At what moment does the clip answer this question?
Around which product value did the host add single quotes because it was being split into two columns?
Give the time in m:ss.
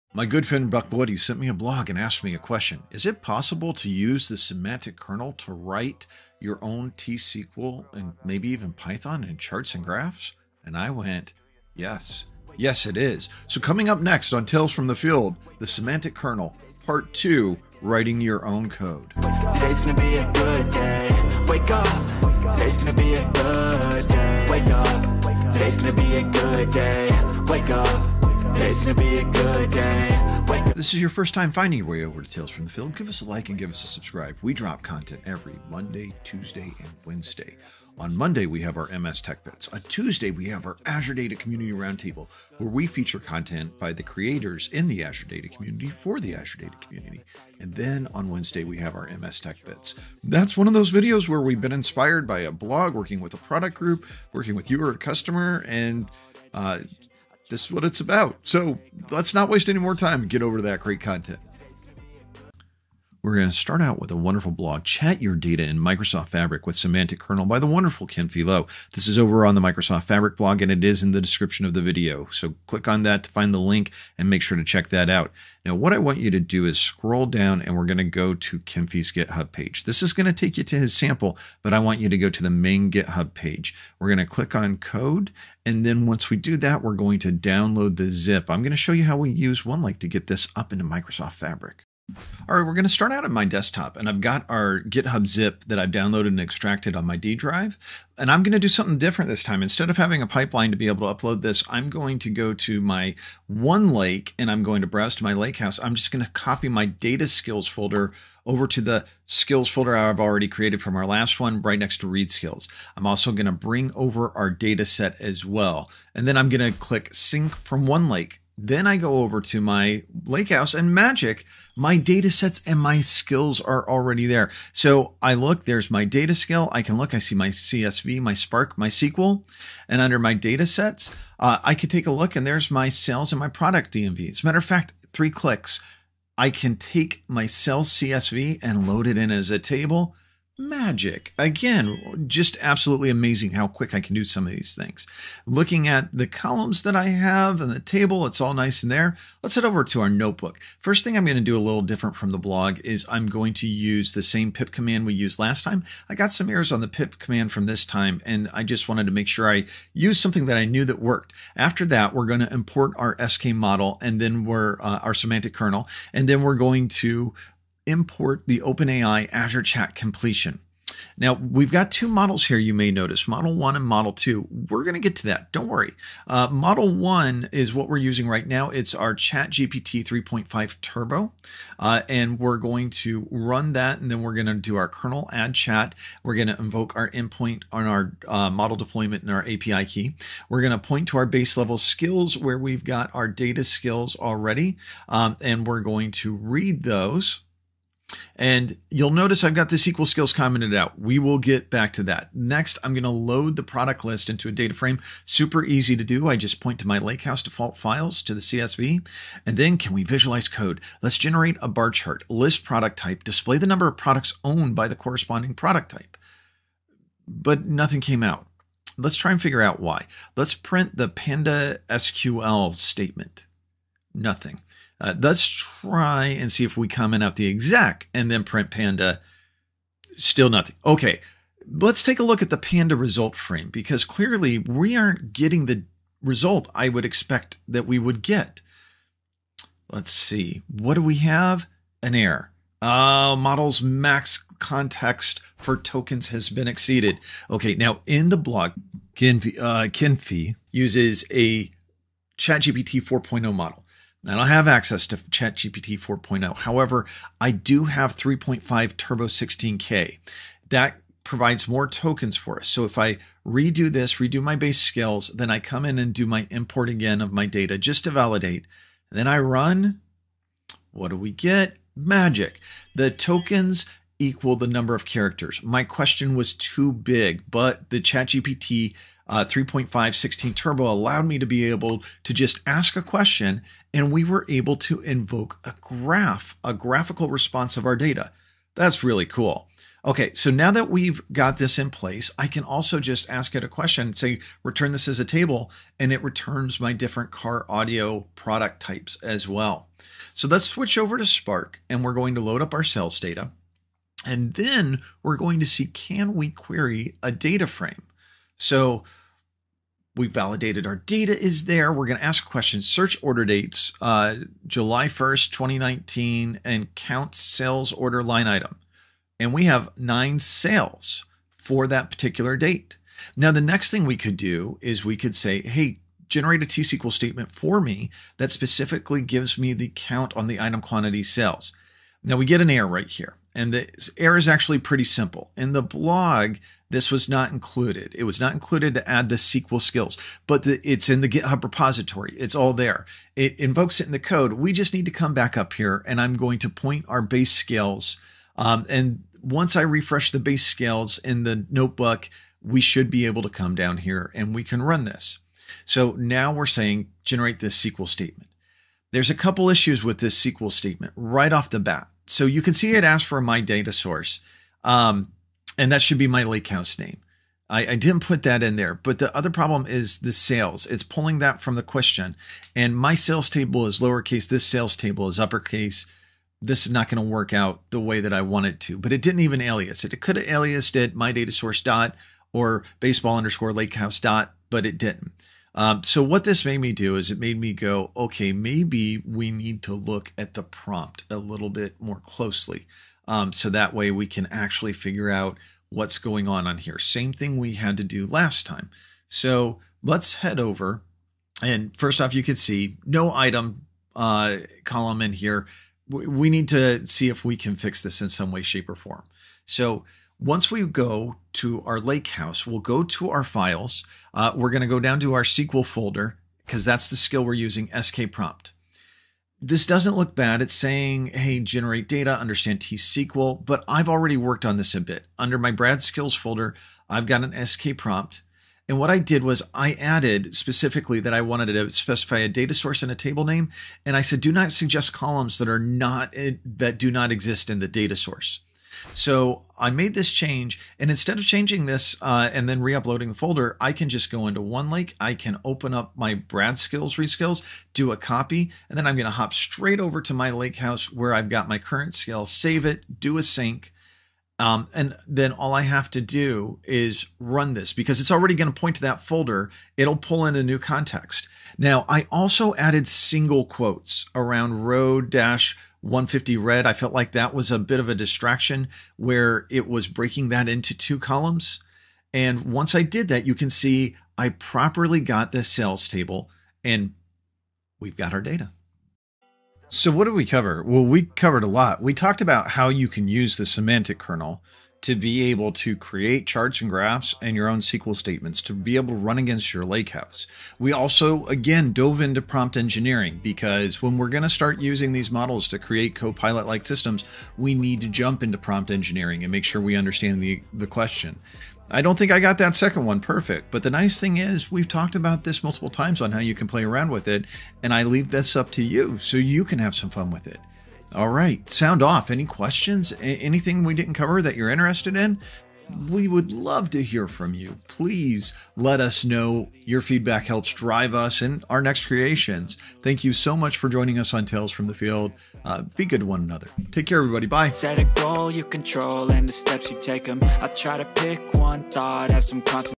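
7:44.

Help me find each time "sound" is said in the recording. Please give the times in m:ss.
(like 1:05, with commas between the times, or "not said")
8:31.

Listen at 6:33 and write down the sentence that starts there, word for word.
Um, so that way we can actually figure out what's going on on here.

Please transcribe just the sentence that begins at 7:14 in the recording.
And I said, do not suggest columns that are not eh, that do not exist in the data source.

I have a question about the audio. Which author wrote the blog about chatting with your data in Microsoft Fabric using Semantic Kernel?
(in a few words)
Kinfey Lo.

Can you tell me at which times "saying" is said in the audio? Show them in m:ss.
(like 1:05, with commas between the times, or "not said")
5:56, 7:00.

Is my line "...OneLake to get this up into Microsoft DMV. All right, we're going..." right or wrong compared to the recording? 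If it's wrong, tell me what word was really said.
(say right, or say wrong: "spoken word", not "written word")
wrong: "Fabric", not "DMV".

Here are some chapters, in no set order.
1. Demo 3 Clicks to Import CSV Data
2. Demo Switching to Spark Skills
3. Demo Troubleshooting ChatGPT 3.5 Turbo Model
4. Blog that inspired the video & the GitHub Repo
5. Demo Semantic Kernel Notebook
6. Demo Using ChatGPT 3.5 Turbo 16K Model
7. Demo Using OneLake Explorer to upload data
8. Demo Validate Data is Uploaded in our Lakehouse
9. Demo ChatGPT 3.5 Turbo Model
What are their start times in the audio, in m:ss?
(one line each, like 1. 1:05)
1. 2:11
2. 5:00
3. 3:57
4. 1:04
5. 2:29
6. 4:14
7. 1:32
8. 1:58
9. 2:51.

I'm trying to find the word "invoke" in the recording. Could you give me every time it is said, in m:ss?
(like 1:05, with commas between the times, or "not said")
3:06, 4:45, 5:43.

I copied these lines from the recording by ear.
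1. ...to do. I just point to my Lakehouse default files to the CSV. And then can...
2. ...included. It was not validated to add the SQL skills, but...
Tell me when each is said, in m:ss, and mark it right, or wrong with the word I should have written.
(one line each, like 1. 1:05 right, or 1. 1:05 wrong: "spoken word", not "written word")
1. 3:25 right
2. 5:37 wrong: "included", not "validated".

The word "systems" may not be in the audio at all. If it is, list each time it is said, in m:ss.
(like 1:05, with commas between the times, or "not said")
8:16.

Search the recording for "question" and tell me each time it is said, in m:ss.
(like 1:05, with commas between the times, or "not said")
0:02, 4:35, 4:43, 4:53, 5:12, 6:11, 8:20, 8:32.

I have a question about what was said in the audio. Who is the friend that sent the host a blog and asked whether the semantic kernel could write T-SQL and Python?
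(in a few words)
Buck Woody.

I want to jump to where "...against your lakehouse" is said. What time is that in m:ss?
8:09.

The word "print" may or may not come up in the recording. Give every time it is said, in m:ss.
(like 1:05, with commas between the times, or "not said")
3:40, 3:48.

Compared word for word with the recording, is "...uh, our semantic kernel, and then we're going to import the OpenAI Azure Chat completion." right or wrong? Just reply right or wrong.
right.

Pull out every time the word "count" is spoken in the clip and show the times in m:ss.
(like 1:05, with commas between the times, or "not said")
5:16, 5:29.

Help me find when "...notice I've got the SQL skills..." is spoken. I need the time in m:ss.
3:19.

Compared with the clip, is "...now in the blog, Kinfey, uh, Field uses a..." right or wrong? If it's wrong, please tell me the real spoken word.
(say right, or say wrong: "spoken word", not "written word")
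wrong: "Kinfey", not "Field".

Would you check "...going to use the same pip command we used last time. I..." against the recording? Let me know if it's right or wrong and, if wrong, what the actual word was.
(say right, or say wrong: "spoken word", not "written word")
right.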